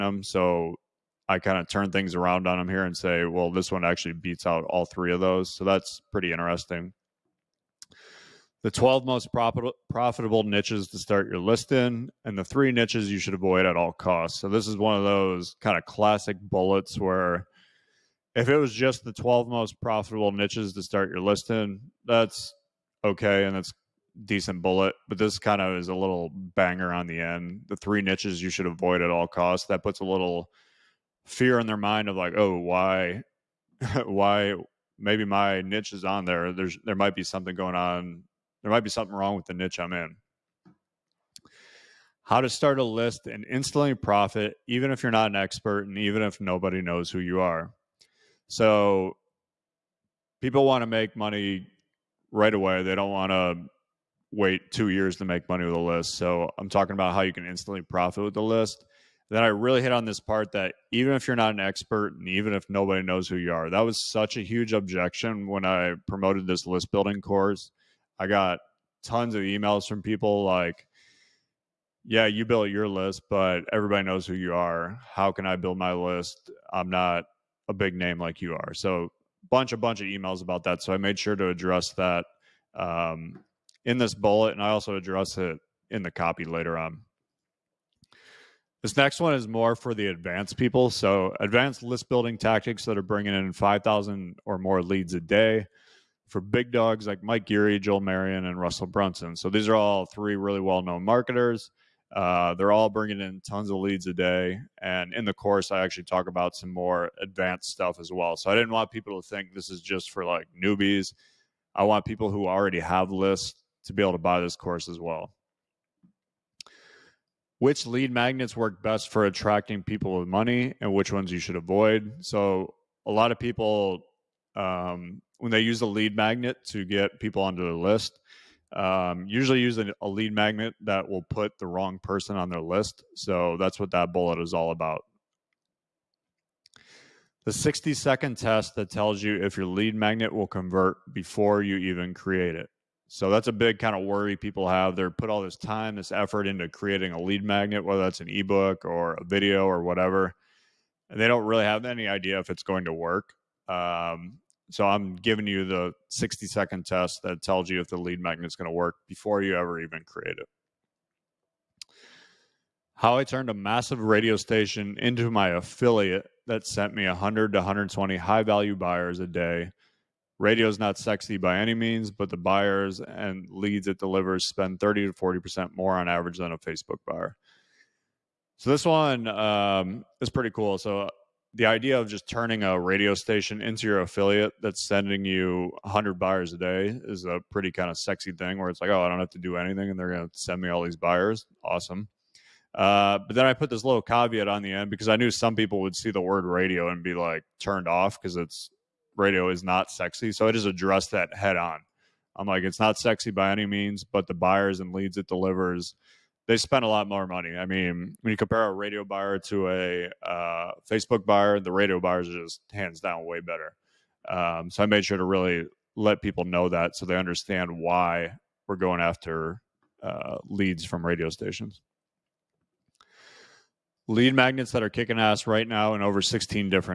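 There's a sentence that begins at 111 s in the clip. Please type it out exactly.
I want people who already have lists to be able to buy this course as well.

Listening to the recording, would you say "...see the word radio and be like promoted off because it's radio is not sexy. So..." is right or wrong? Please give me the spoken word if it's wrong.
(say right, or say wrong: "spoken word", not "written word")
wrong: "turned", not "promoted".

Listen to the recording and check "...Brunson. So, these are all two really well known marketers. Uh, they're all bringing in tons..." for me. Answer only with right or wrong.
wrong.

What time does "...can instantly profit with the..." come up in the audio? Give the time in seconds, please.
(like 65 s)
57 s.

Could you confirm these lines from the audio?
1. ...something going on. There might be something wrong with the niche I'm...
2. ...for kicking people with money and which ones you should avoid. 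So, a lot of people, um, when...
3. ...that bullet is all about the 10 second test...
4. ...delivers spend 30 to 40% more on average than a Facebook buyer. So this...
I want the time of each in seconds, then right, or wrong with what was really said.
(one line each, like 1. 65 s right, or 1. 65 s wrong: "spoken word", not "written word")
1. 37 s right
2. 119 s wrong: "attracting", not "kicking"
3. 133 s wrong: "60", not "10"
4. 173 s right.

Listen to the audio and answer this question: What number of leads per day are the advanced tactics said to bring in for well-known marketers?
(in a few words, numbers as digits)
5,000.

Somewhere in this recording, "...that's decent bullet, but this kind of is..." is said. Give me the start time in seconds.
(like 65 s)
23 s.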